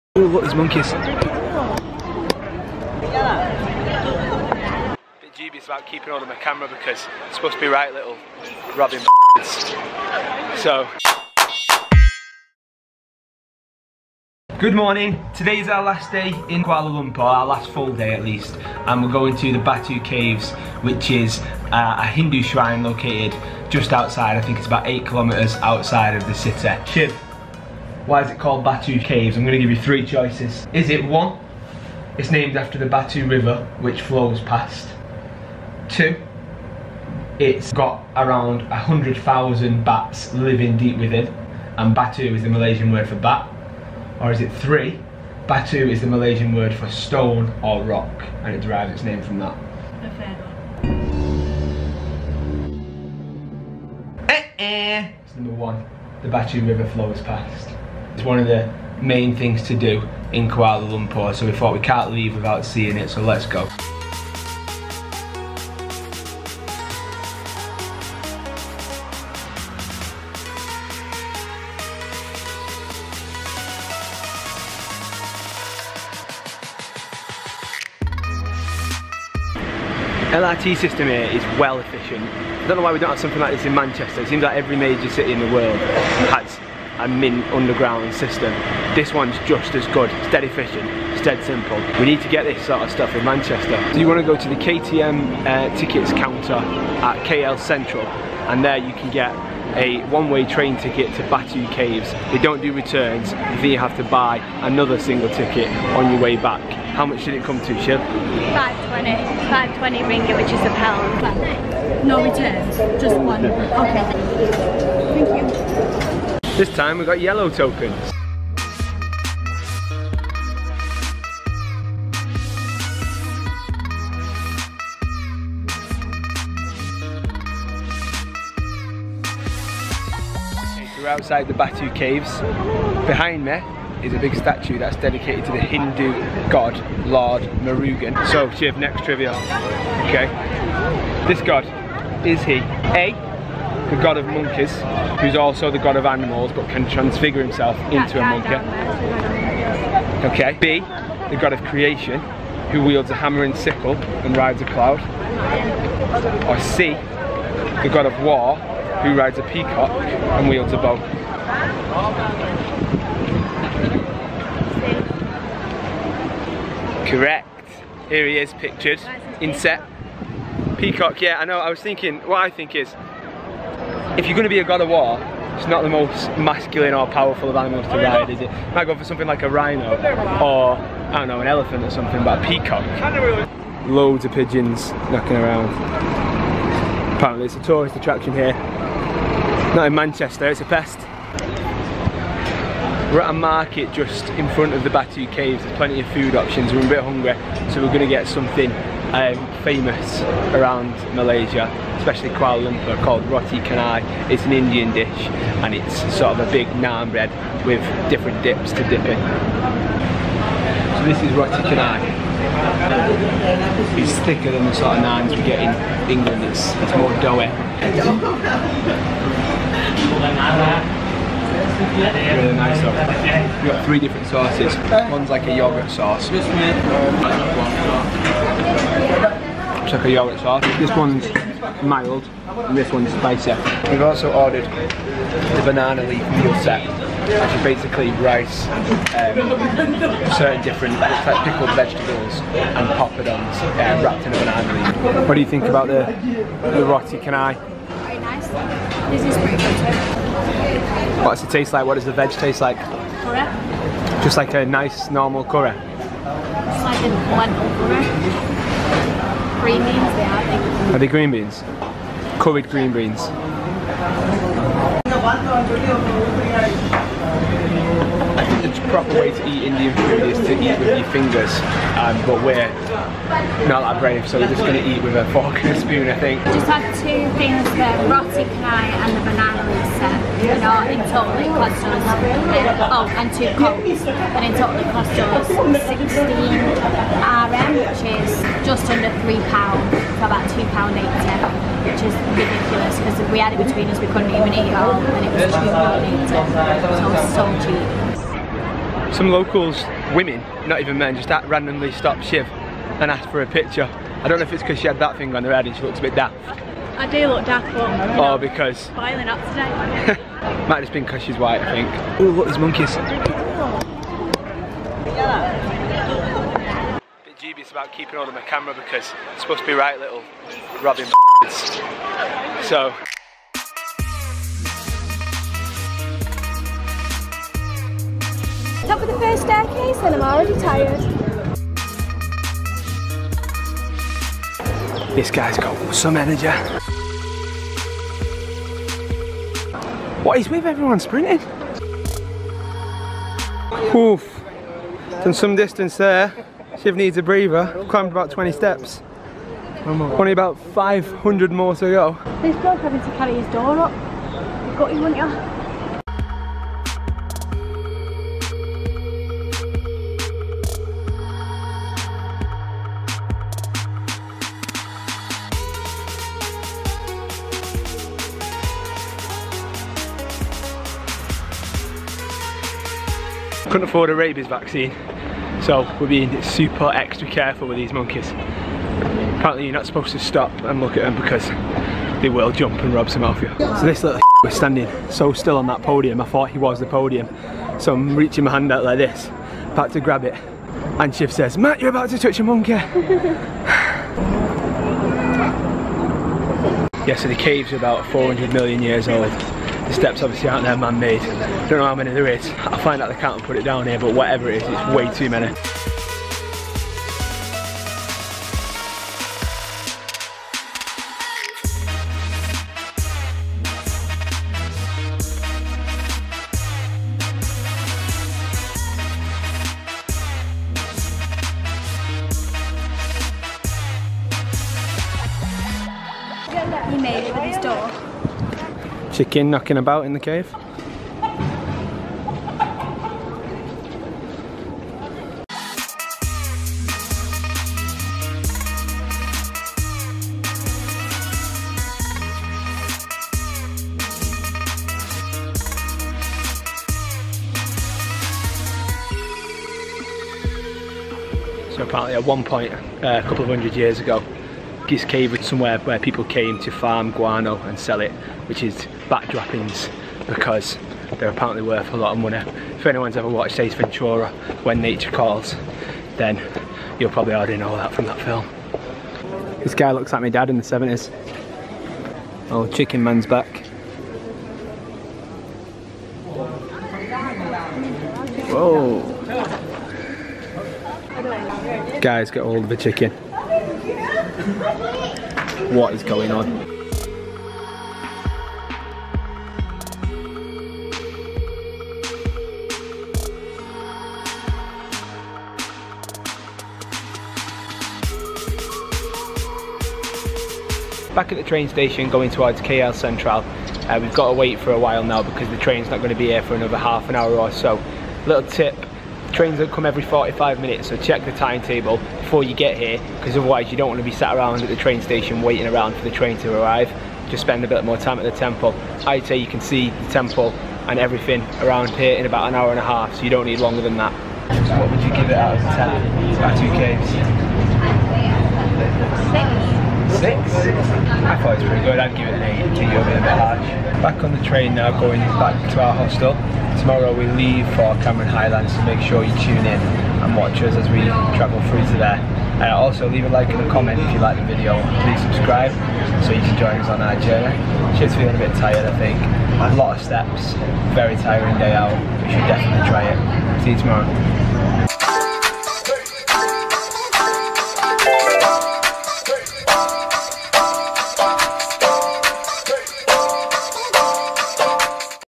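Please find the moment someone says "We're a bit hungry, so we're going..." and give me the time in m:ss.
3:16.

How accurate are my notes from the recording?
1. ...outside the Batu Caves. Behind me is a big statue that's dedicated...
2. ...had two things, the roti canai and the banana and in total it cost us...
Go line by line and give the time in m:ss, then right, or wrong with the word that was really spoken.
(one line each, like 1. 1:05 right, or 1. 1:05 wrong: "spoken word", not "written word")
1. 2:11 right
2. 4:36 right.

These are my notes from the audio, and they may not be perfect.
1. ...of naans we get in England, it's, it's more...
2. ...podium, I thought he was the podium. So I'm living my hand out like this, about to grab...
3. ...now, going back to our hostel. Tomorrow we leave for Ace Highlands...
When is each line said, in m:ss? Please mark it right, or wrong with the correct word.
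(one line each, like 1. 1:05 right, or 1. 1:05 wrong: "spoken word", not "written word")
1. 3:34 right
2. 6:25 wrong: "reaching", not "living"
3. 8:54 wrong: "Cameron", not "Ace".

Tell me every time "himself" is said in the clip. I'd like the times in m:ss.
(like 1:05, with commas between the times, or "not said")
2:27.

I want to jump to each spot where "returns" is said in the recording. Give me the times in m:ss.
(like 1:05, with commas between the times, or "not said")
1:42, 1:52.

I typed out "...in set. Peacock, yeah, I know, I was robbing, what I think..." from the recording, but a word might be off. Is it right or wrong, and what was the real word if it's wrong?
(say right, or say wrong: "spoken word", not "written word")
wrong: "thinking", not "robbing".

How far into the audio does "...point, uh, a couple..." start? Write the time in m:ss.
7:32.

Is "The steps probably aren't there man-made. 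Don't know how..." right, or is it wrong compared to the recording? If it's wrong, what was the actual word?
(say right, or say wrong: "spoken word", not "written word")
wrong: "obviously", not "probably".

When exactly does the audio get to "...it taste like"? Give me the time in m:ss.
4:11.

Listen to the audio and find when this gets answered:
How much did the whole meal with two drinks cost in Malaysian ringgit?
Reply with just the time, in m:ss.
4:45.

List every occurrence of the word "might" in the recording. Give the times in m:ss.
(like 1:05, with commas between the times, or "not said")
2:58, 5:10.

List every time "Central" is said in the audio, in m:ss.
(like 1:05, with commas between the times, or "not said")
1:37, 8:22.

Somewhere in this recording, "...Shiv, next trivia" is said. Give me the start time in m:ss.
2:18.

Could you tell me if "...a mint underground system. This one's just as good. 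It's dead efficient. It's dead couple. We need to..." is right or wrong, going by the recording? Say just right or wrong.
wrong.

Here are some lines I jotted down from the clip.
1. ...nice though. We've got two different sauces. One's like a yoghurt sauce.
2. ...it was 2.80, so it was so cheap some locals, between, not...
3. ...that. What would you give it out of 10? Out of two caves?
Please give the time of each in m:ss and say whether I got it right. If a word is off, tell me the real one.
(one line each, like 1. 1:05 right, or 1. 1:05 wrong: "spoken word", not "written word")
1. 3:42 wrong: "three", not "two"
2. 4:55 wrong: "women", not "between"
3. 8:43 right.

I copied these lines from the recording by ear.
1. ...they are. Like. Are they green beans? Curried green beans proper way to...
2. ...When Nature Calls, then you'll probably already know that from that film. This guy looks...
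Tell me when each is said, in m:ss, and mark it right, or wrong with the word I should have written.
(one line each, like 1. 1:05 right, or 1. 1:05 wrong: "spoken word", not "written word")
1. 4:20 right
2. 7:44 right.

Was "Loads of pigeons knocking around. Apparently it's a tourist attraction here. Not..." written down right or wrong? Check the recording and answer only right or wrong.
right.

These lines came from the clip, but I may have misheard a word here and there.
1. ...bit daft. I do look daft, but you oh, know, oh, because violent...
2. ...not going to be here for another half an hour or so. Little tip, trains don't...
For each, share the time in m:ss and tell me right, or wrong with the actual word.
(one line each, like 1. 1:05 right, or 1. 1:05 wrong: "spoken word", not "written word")
1. 5:06 right
2. 8:25 right.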